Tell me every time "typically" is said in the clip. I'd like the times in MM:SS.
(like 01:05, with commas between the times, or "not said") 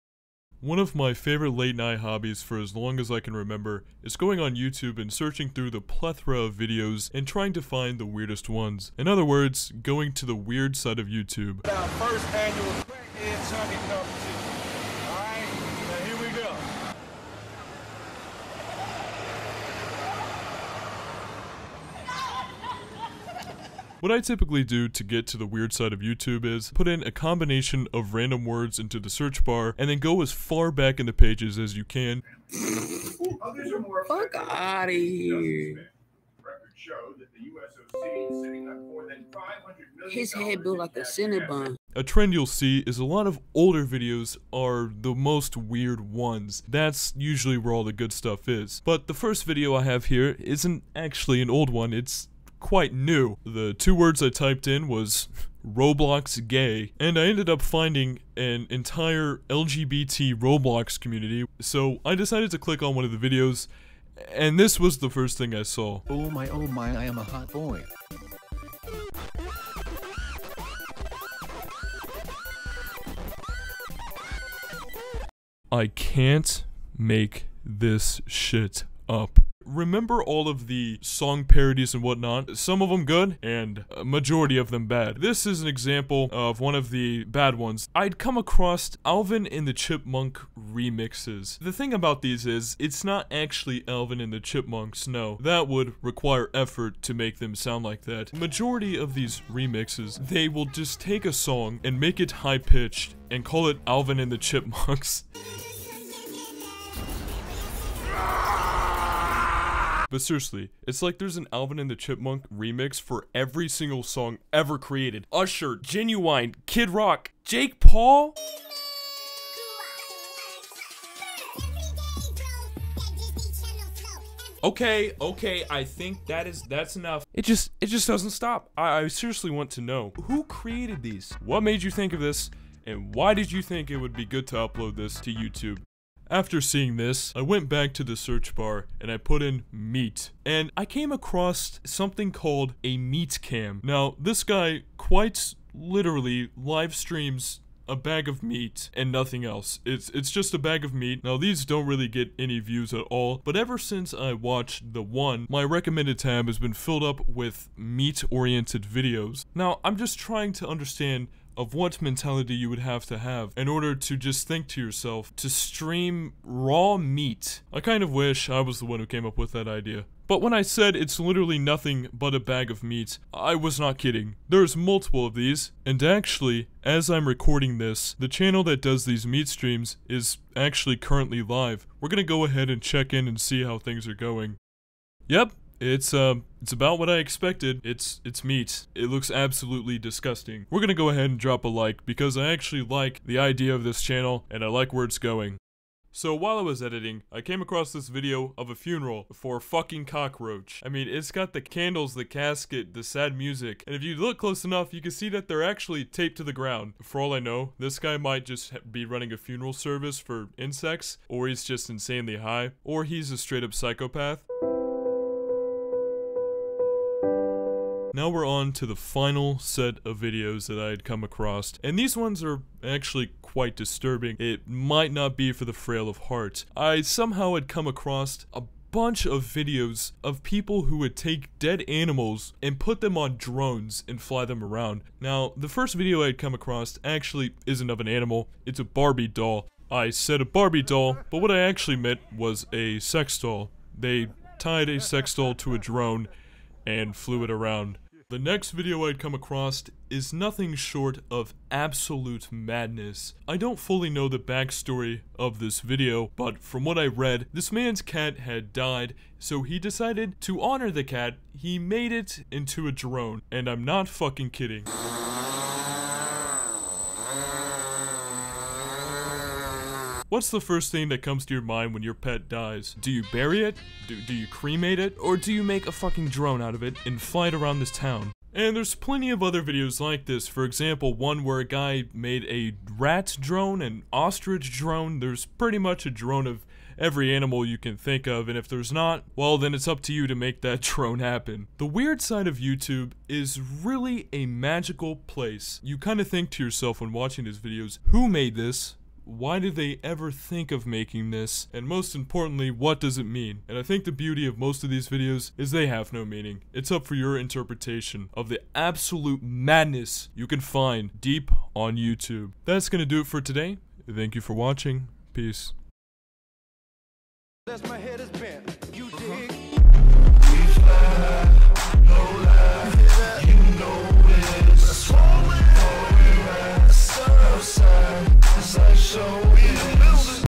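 00:24.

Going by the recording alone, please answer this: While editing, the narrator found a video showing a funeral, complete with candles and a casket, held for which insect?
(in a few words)
cockroach.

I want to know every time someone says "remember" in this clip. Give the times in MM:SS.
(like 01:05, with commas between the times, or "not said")
00:03, 01:19.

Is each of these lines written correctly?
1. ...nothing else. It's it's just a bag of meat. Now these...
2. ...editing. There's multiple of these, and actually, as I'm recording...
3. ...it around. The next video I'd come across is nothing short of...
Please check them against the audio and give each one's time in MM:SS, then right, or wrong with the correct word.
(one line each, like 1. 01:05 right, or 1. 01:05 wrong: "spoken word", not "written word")
1. 02:29 right
2. 02:53 wrong: "kidding", not "editing"
3. 04:07 right.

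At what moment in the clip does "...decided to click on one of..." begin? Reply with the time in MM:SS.
01:02.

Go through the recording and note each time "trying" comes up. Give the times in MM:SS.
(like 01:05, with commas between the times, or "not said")
00:07, 02:40.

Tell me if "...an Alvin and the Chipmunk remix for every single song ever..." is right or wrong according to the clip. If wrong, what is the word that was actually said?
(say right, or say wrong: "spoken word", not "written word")
right.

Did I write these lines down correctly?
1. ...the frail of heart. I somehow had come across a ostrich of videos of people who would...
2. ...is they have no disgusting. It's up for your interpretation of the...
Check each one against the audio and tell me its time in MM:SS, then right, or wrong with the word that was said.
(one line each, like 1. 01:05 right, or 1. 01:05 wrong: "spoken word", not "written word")
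1. 03:45 wrong: "bunch", not "ostrich"
2. 05:05 wrong: "meaning", not "disgusting".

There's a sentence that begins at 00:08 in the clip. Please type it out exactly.
In other words, going to the weird side of YouTube.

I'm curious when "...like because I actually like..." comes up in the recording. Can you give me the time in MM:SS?
03:11.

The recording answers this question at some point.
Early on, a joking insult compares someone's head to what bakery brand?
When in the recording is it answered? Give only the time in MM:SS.
00:41.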